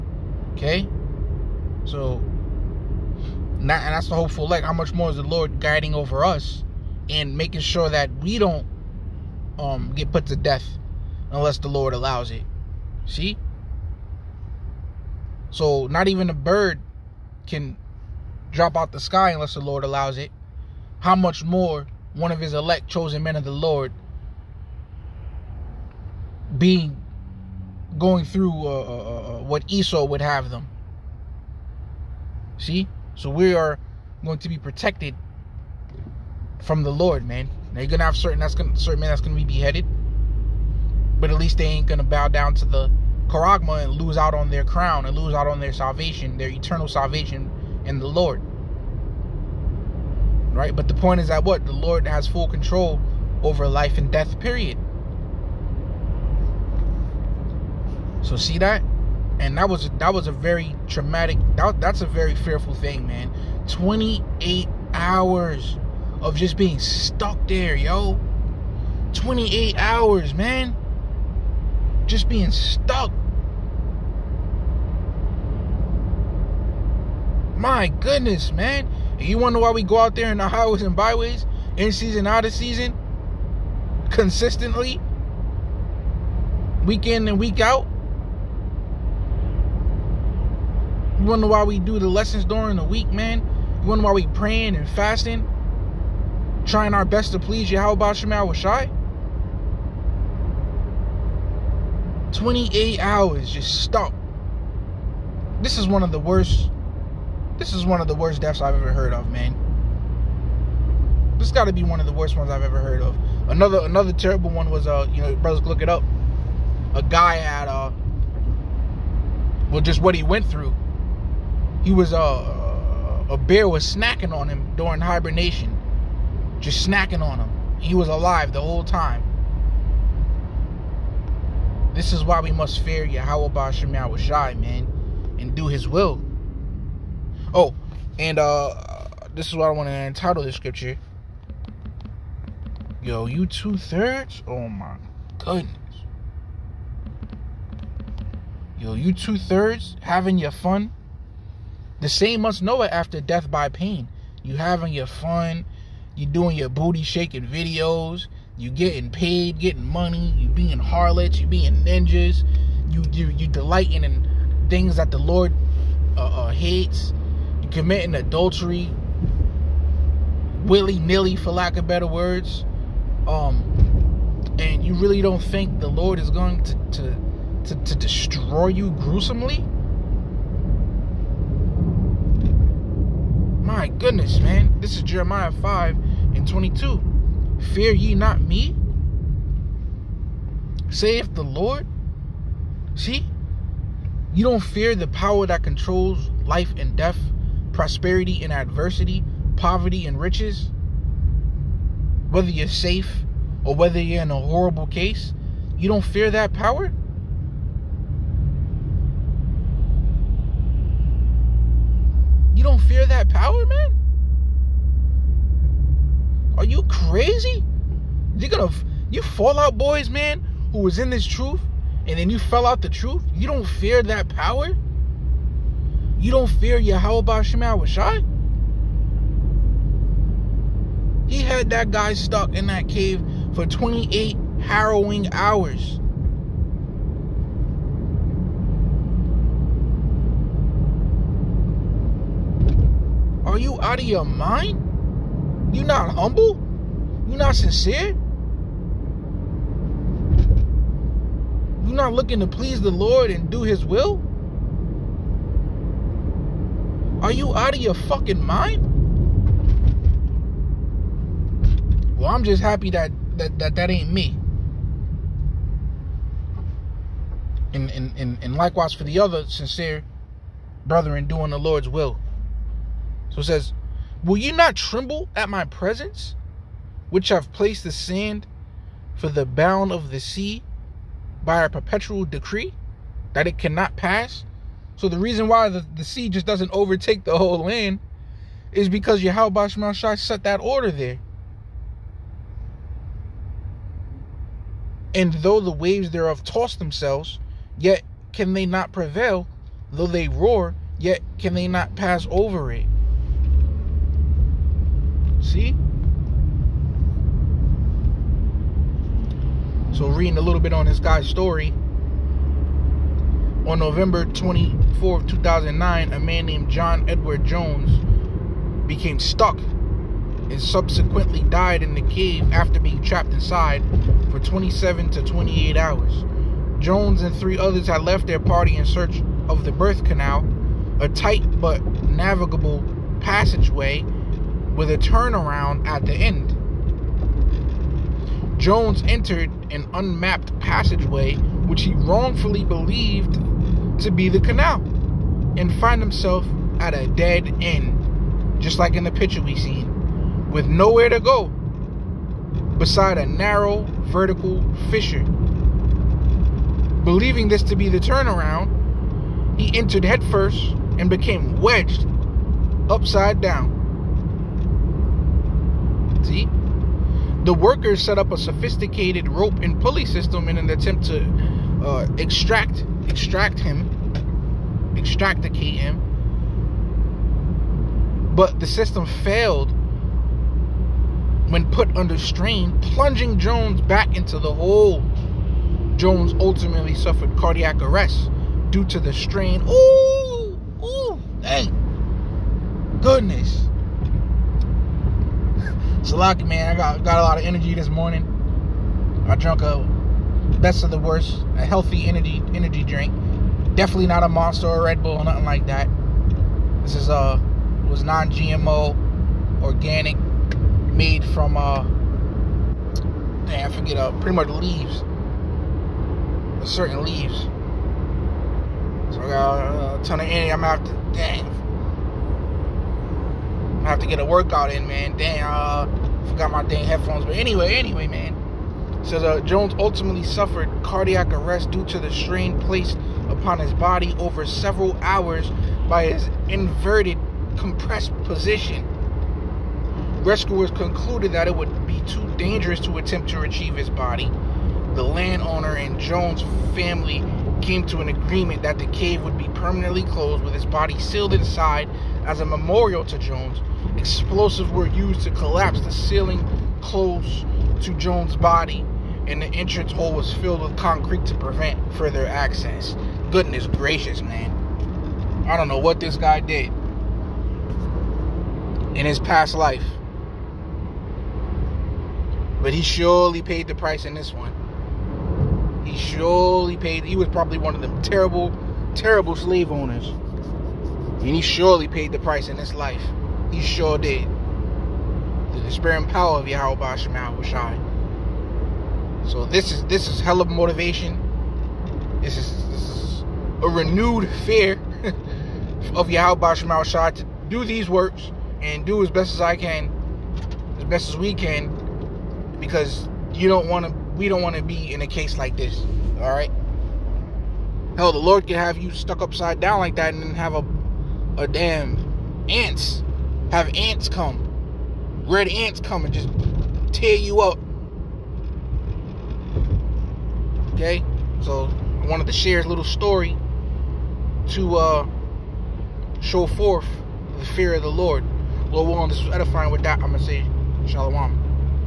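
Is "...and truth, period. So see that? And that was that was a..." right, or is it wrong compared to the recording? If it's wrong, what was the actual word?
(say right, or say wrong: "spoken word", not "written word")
wrong: "death", not "truth".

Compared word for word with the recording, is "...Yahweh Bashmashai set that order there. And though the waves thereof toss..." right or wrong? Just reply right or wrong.
right.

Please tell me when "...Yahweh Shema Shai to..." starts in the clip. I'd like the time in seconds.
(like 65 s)
496 s.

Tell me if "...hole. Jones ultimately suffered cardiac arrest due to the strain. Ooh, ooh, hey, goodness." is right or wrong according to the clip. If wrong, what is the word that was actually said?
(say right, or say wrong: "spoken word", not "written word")
right.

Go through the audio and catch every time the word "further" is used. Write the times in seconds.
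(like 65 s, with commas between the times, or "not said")
461 s.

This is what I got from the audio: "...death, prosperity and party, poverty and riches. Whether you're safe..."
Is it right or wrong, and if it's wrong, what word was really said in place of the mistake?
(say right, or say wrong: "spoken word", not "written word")
wrong: "adversity", not "party".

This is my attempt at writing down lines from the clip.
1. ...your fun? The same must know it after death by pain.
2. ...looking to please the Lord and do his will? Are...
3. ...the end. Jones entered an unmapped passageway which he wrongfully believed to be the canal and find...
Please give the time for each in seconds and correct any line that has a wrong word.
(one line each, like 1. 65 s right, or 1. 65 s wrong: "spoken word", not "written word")
1. 150 s right
2. 252 s right
3. 336 s right.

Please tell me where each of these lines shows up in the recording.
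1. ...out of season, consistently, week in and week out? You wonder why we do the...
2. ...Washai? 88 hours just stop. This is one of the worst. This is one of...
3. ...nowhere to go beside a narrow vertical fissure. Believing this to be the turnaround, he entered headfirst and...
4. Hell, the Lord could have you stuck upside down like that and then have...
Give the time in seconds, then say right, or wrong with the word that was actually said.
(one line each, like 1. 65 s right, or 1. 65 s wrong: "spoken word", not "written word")
1. 82 s right
2. 98 s wrong: "28", not "88"
3. 350 s right
4. 507 s right.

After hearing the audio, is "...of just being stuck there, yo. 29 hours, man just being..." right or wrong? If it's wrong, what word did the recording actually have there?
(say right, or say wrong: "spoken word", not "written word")
wrong: "28", not "29".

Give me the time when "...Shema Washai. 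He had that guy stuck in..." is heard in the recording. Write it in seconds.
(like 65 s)
227 s.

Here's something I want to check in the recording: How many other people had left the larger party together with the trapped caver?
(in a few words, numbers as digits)
3.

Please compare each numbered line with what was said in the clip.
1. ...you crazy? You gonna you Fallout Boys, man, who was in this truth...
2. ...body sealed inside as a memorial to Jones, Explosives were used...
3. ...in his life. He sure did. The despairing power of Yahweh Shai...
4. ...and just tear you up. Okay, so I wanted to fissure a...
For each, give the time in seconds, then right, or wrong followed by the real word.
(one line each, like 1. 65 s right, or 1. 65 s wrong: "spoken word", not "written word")
1. 216 s right
2. 450 s right
3. 482 s wrong: "Shema", not "Shai"
4. 516 s wrong: "share", not "fissure".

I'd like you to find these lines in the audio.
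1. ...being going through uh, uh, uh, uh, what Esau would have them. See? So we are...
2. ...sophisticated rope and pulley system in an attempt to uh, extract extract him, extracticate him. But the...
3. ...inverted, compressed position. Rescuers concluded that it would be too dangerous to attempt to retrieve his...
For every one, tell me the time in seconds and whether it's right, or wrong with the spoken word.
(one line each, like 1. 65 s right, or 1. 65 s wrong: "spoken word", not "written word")
1. 26 s right
2. 368 s right
3. 436 s right.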